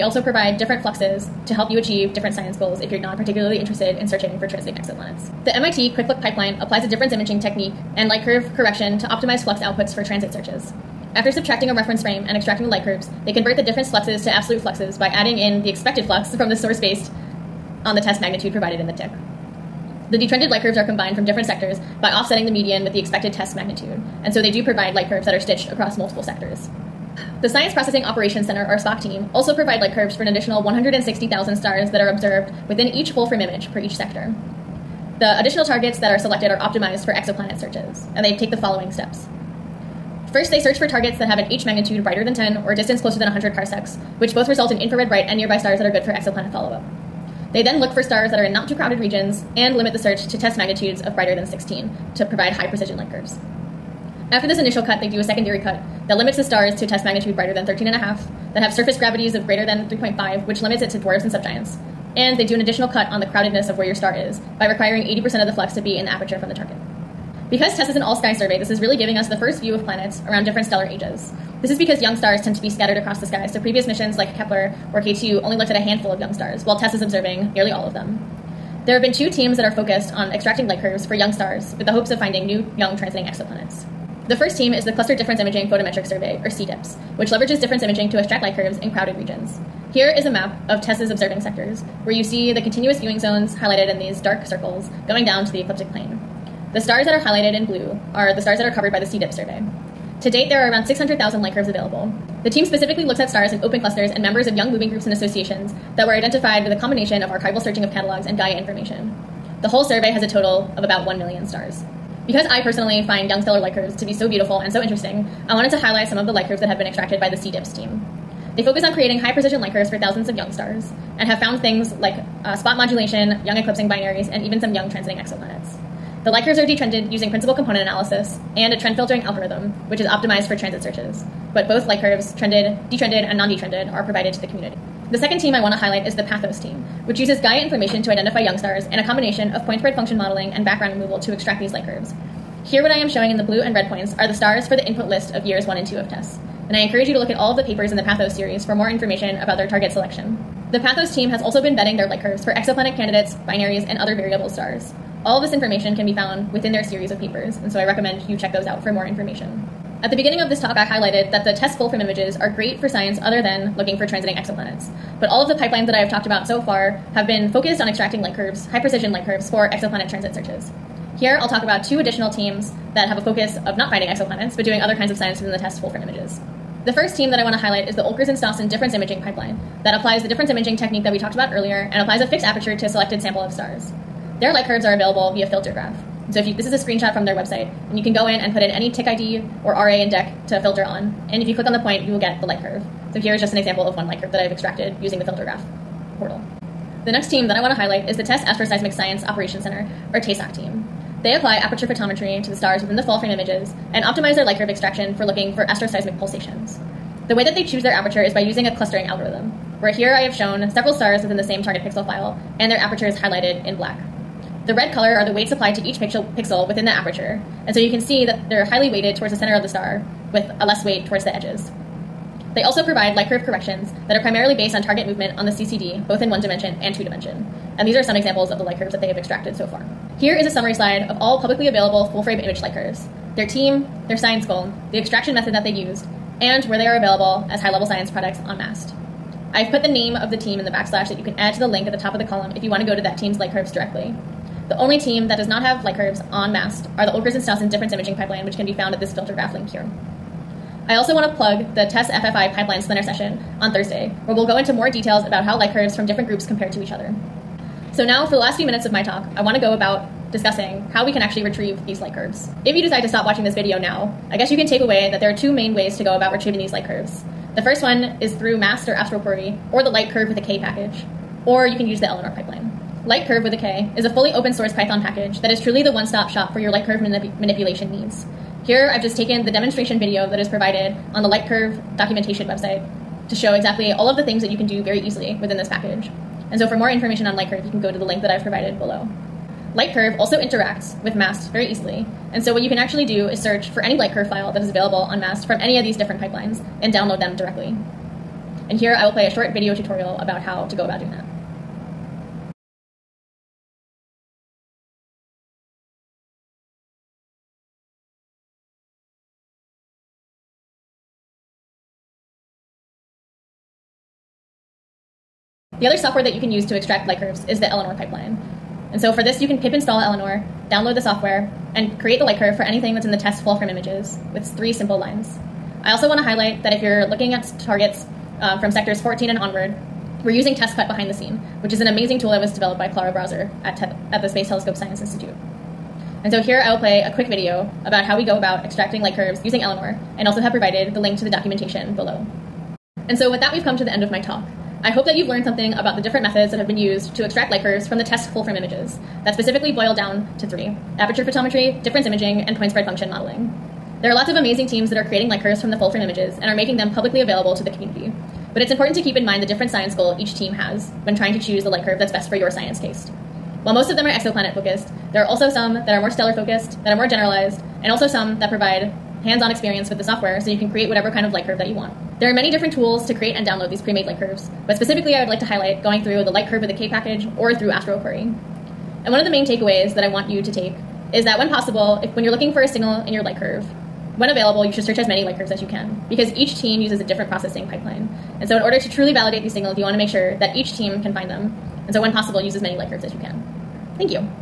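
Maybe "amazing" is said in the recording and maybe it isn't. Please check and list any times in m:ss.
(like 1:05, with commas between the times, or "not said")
5:31, 5:54.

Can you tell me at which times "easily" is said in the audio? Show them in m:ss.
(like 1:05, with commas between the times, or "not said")
4:44, 4:51.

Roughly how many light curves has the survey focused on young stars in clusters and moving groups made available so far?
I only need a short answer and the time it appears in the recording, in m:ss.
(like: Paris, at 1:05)
600,000, at 1:40.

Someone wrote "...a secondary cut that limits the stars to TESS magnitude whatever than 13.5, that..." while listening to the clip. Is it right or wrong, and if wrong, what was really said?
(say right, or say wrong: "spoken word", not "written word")
wrong: "brighter", not "whatever".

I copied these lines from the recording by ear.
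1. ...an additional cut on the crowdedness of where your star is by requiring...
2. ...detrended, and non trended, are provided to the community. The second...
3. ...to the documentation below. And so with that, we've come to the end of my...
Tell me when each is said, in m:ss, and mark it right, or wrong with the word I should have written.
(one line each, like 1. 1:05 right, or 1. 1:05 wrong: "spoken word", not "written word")
1. 1:02 right
2. 2:12 wrong: "detrended", not "trended"
3. 5:41 right.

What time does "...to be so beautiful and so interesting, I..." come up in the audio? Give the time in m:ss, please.
1:53.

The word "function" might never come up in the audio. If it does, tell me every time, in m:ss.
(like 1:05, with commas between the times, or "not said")
2:19, 5:52.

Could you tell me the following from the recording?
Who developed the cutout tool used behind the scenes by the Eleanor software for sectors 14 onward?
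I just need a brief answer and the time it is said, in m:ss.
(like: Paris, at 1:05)
Clara Brasseur, at 5:32.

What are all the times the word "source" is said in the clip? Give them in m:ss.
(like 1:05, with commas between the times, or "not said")
0:16, 4:34.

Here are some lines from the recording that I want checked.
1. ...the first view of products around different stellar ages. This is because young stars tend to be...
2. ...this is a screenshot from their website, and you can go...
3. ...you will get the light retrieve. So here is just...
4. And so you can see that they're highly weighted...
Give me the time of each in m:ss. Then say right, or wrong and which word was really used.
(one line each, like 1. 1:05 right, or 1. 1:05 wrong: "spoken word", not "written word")
1. 1:09 wrong: "planets", not "products"
2. 3:06 right
3. 3:12 wrong: "curve", not "retrieve"
4. 3:37 right.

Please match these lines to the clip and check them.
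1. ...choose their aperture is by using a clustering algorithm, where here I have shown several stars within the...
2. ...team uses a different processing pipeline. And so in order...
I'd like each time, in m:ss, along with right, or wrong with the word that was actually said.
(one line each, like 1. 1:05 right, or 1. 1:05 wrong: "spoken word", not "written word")
1. 3:27 right
2. 6:26 right.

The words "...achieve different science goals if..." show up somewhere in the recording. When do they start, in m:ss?
0:01.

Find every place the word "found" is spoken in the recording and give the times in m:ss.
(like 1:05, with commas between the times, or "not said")
2:01, 2:36, 4:08.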